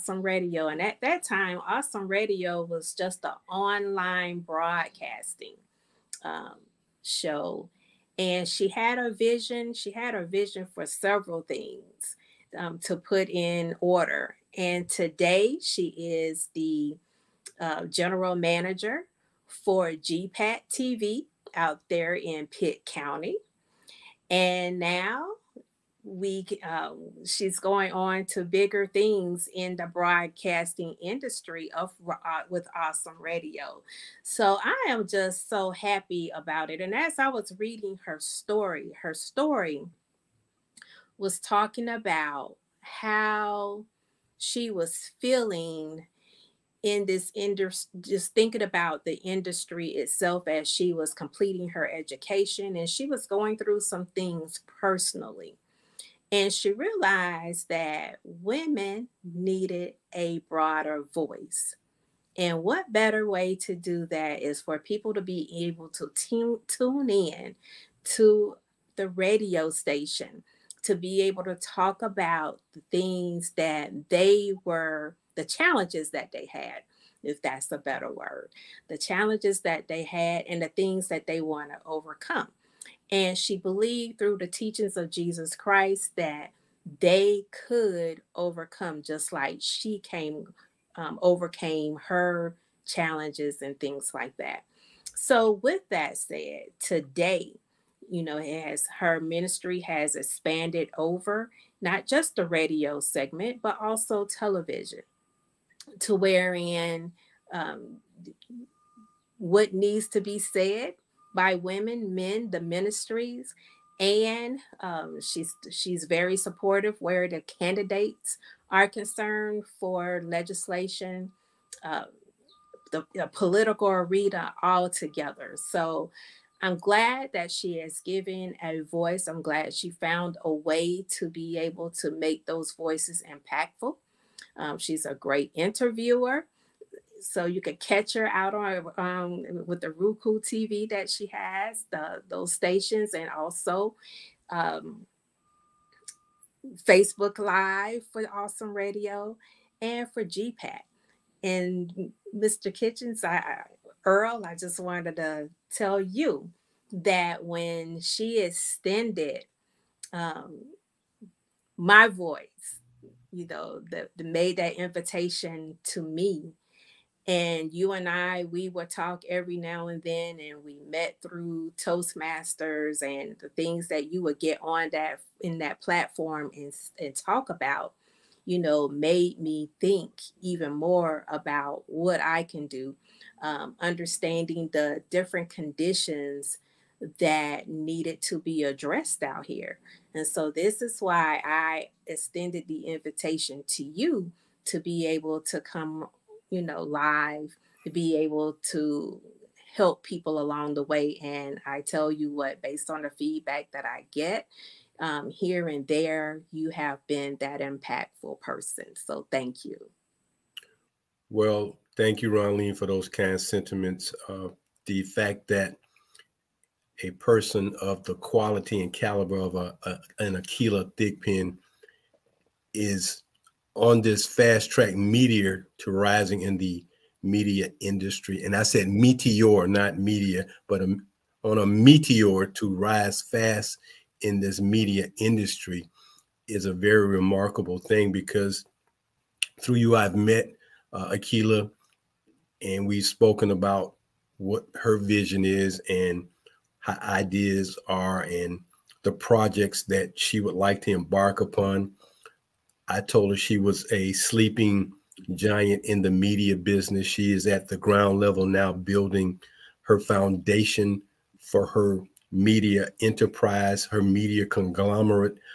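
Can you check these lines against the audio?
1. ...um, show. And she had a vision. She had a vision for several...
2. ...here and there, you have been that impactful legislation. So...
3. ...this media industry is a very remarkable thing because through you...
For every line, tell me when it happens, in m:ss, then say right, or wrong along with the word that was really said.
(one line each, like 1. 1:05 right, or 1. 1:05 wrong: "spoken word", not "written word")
1. 0:06 right
2. 3:25 wrong: "person", not "legislation"
3. 3:54 right.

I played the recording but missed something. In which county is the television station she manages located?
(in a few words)
Pitt County.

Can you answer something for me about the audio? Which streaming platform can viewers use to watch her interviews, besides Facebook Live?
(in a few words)
Roku TV.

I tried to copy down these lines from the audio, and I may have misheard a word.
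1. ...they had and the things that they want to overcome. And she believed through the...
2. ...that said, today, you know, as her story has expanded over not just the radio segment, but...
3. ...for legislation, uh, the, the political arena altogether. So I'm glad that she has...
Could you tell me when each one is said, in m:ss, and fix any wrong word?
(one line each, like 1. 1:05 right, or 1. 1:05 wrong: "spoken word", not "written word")
1. 1:19 right
2. 1:35 wrong: "ministry", not "story"
3. 1:59 right.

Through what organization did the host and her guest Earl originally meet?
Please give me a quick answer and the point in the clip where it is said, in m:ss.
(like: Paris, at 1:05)
Toastmasters, at 2:51.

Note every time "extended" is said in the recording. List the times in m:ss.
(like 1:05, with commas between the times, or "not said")
2:38, 3:12.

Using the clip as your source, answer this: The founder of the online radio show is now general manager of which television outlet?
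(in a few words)
GPAT TV.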